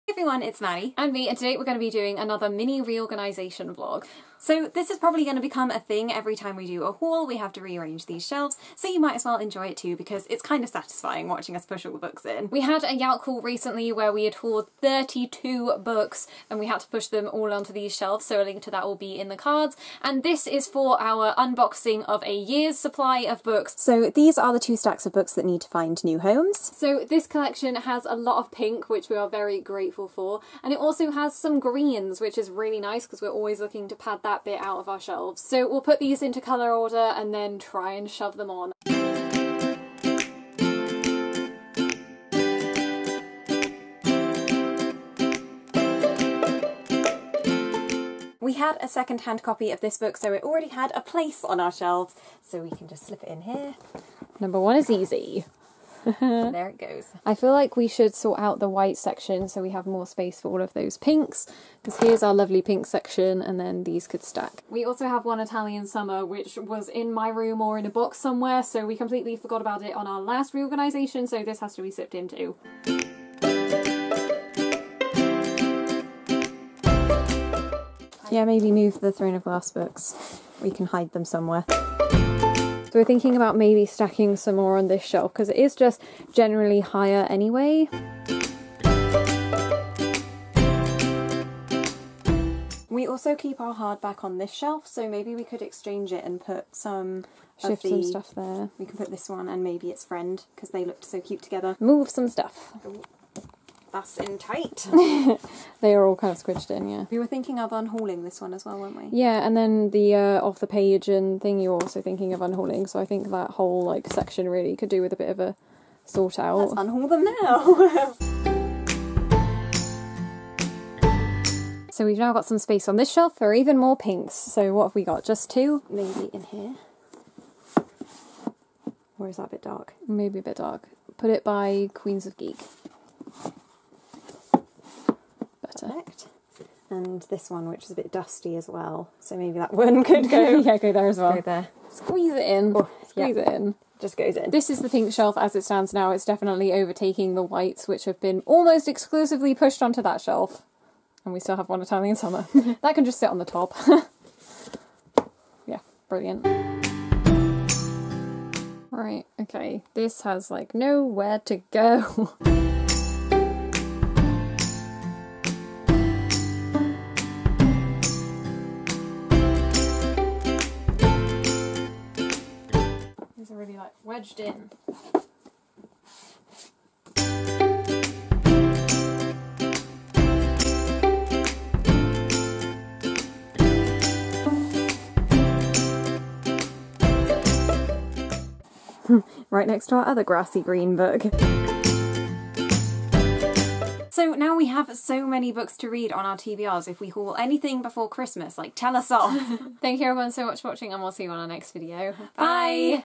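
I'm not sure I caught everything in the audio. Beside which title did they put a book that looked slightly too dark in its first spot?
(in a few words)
Queens of Geek.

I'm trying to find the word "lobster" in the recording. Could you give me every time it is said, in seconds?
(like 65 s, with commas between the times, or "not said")
not said.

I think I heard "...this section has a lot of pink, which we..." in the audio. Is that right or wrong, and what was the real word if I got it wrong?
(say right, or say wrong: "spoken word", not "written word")
wrong: "collection", not "section".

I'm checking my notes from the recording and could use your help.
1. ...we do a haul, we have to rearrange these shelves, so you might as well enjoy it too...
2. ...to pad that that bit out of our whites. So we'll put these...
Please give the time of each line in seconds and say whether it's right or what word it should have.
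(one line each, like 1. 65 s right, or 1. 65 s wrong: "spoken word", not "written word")
1. 6 s right
2. 33 s wrong: "shelves", not "whites".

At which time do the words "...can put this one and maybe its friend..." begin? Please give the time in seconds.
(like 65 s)
98 s.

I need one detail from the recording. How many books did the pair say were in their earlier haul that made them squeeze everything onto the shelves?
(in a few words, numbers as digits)
32.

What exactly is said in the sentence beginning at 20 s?
And this is for our unboxing of a year's supply of books.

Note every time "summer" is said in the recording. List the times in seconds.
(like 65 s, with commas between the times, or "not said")
65 s, 152 s.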